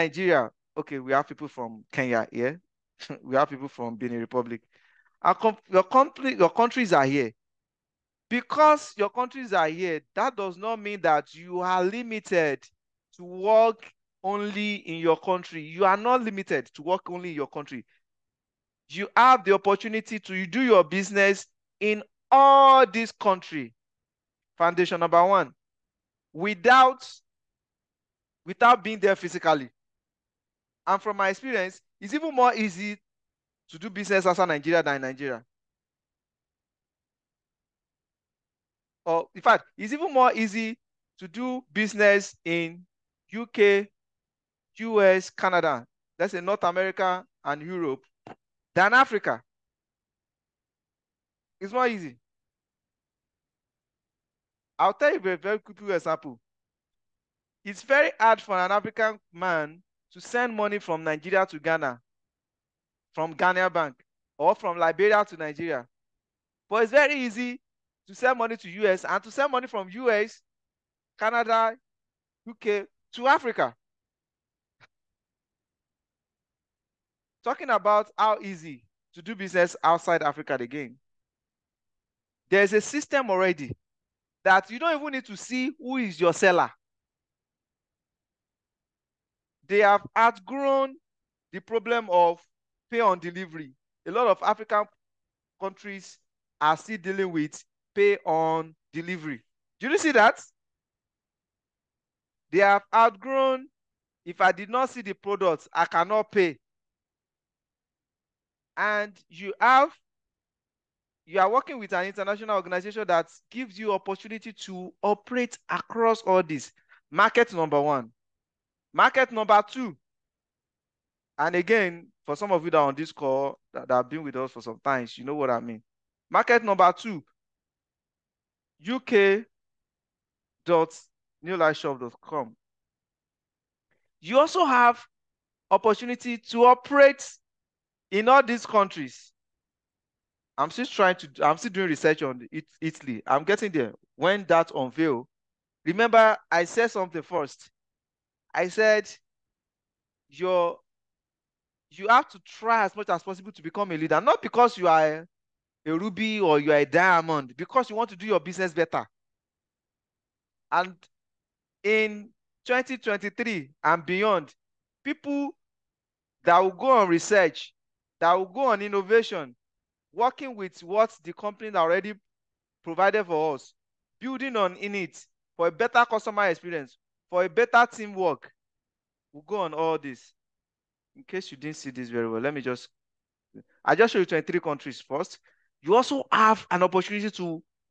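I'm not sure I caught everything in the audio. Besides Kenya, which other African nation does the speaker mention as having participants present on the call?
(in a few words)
Benin Republic.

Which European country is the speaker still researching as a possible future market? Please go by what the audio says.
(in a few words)
Italy.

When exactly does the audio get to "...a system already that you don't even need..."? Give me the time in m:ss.
1:22.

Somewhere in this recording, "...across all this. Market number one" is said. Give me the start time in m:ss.
1:55.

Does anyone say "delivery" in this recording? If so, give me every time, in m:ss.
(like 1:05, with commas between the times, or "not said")
1:33, 1:38.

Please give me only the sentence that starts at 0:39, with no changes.
Or in fact, it's even more easy to do business in UK, US, Canada, thats in North America and Europe, than Africa.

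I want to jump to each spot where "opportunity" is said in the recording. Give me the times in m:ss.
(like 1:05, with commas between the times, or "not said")
0:19, 1:53, 2:15, 3:06.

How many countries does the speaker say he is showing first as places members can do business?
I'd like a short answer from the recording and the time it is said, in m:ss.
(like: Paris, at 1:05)
23, at 3:04.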